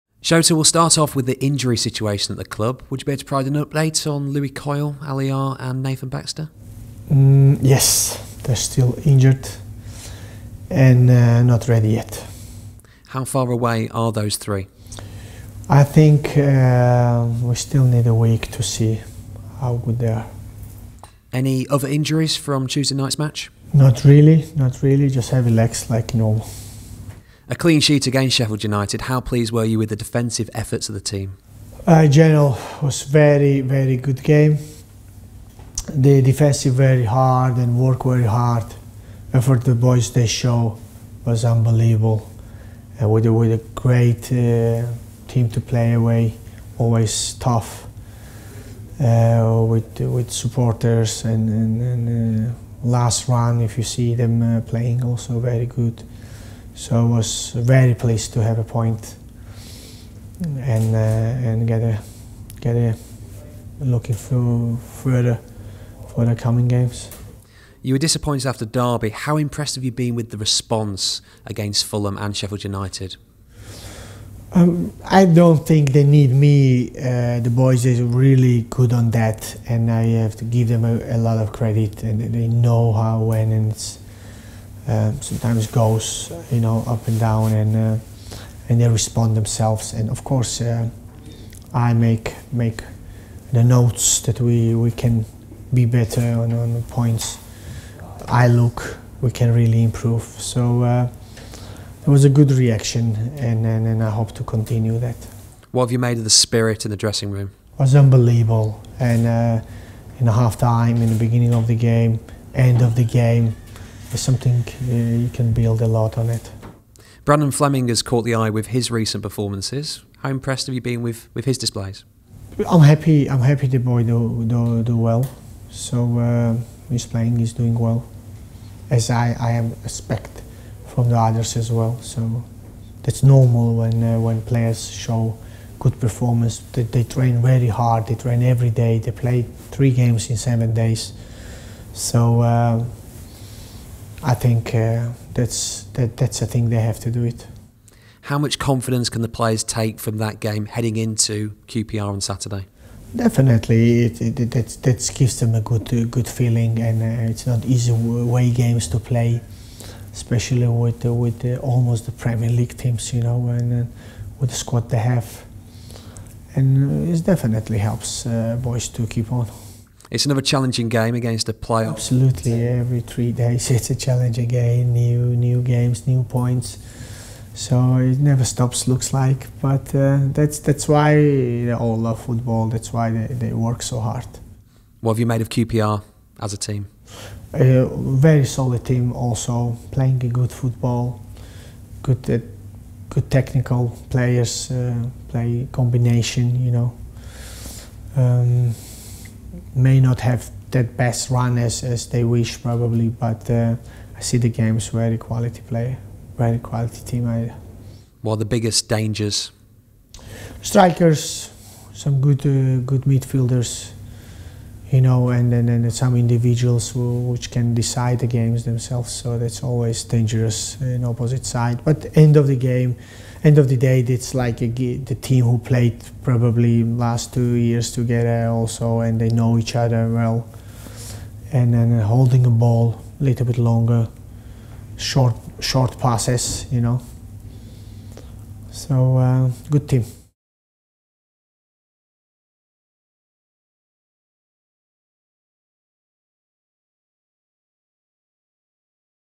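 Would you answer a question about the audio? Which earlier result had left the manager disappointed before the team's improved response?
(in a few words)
Derby.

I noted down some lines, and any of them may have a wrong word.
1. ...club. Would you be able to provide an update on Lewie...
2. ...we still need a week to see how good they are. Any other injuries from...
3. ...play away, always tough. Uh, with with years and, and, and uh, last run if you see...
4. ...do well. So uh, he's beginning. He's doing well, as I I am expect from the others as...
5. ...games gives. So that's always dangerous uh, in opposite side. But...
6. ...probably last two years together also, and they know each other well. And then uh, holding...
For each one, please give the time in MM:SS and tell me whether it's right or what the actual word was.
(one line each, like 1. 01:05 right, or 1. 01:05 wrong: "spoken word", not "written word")
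1. 00:02 right
2. 00:17 right
3. 00:45 wrong: "supporters", not "years"
4. 02:04 wrong: "playing", not "beginning"
5. 03:38 wrong: "themselves", not "gives"
6. 03:46 right.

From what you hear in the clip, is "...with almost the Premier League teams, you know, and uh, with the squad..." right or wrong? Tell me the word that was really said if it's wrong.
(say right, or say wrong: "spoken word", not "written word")
right.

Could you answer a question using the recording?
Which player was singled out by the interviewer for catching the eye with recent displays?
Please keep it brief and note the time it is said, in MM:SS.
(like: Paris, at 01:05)
Brandon Fleming, at 01:57.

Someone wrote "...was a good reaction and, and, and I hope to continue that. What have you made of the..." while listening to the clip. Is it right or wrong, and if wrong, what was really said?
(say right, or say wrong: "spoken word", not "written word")
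right.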